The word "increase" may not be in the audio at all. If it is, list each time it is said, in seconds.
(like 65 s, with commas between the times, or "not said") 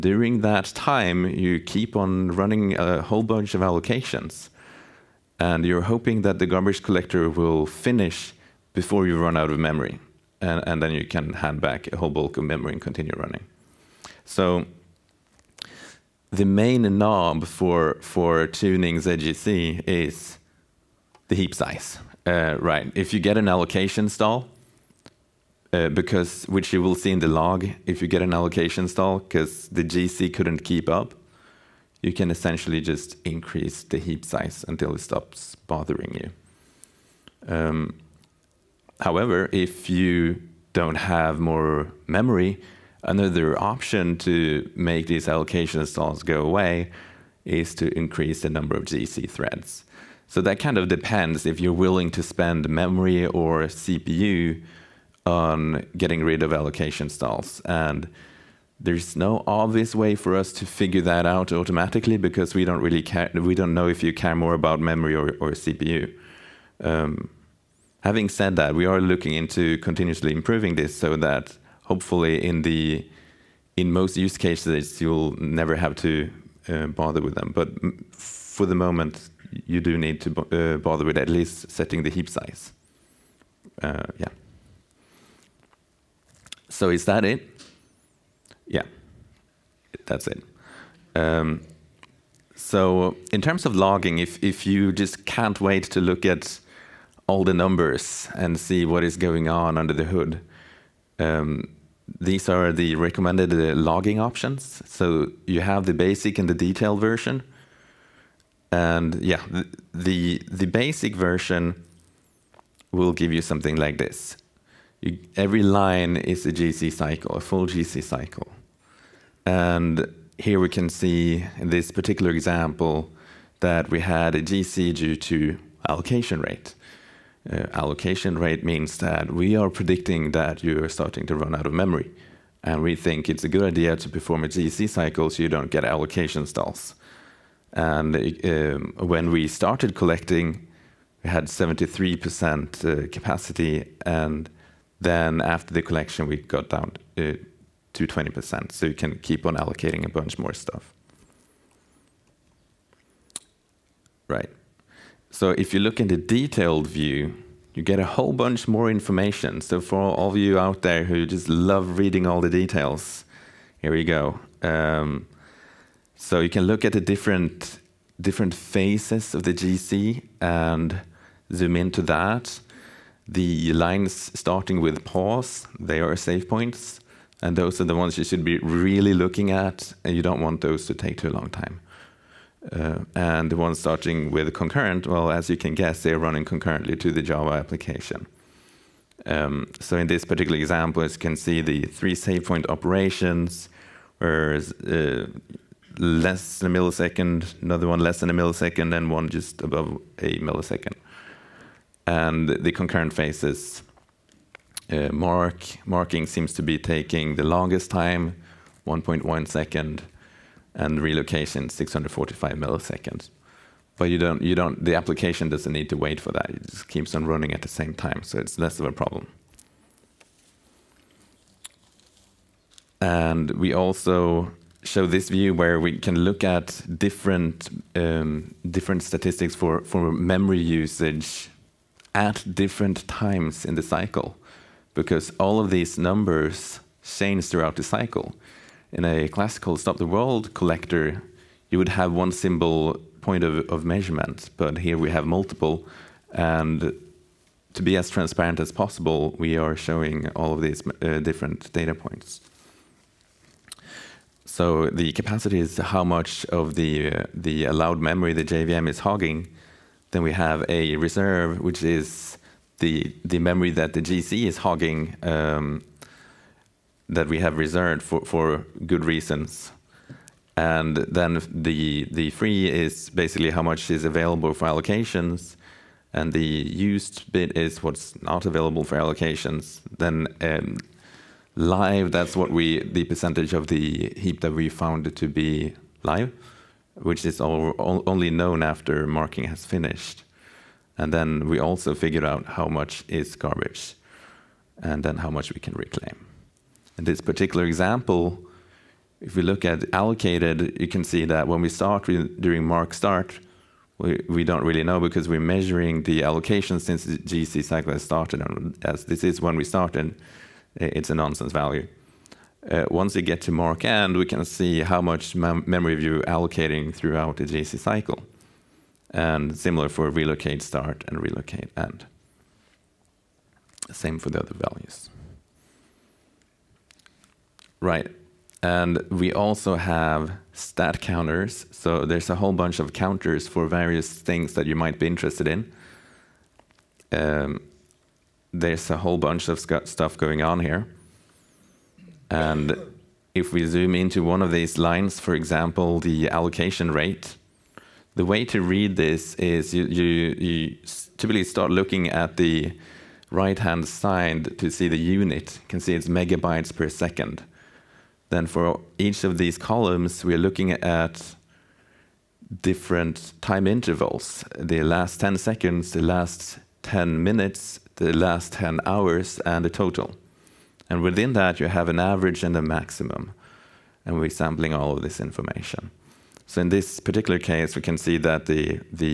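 33 s, 47 s.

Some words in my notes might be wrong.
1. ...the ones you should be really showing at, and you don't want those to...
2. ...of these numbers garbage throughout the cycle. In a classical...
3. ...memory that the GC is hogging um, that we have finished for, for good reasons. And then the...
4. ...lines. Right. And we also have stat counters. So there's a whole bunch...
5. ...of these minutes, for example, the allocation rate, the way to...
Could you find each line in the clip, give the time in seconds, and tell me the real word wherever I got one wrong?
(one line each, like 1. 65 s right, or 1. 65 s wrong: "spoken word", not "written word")
1. 177 s wrong: "looking", not "showing"
2. 235 s wrong: "change", not "garbage"
3. 263 s wrong: "reserved", not "finished"
4. 324 s wrong: "values", not "lines"
5. 344 s wrong: "lines", not "minutes".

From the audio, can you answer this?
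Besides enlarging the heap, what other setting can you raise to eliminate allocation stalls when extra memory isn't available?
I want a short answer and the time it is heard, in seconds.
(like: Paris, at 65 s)
Number of GC threads, at 48 s.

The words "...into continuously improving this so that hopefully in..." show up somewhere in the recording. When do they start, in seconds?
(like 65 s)
69 s.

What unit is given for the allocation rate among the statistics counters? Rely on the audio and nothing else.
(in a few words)
Megabytes per second.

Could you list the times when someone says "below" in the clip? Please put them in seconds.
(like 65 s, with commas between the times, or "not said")
not said.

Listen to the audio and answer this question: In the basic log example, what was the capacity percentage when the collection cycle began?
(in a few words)
73%.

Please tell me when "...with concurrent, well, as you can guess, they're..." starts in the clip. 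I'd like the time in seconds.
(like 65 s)
184 s.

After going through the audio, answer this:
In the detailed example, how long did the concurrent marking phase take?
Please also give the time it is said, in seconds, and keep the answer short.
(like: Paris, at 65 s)
1.1 seconds, at 208 s.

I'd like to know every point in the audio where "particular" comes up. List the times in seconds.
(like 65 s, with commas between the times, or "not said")
121 s, 190 s, 297 s, 377 s.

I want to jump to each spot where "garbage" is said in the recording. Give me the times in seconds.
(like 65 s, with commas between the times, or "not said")
6 s, 293 s.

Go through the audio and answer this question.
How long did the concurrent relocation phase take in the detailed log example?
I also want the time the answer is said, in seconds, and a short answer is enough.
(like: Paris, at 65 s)
645 milliseconds, at 211 s.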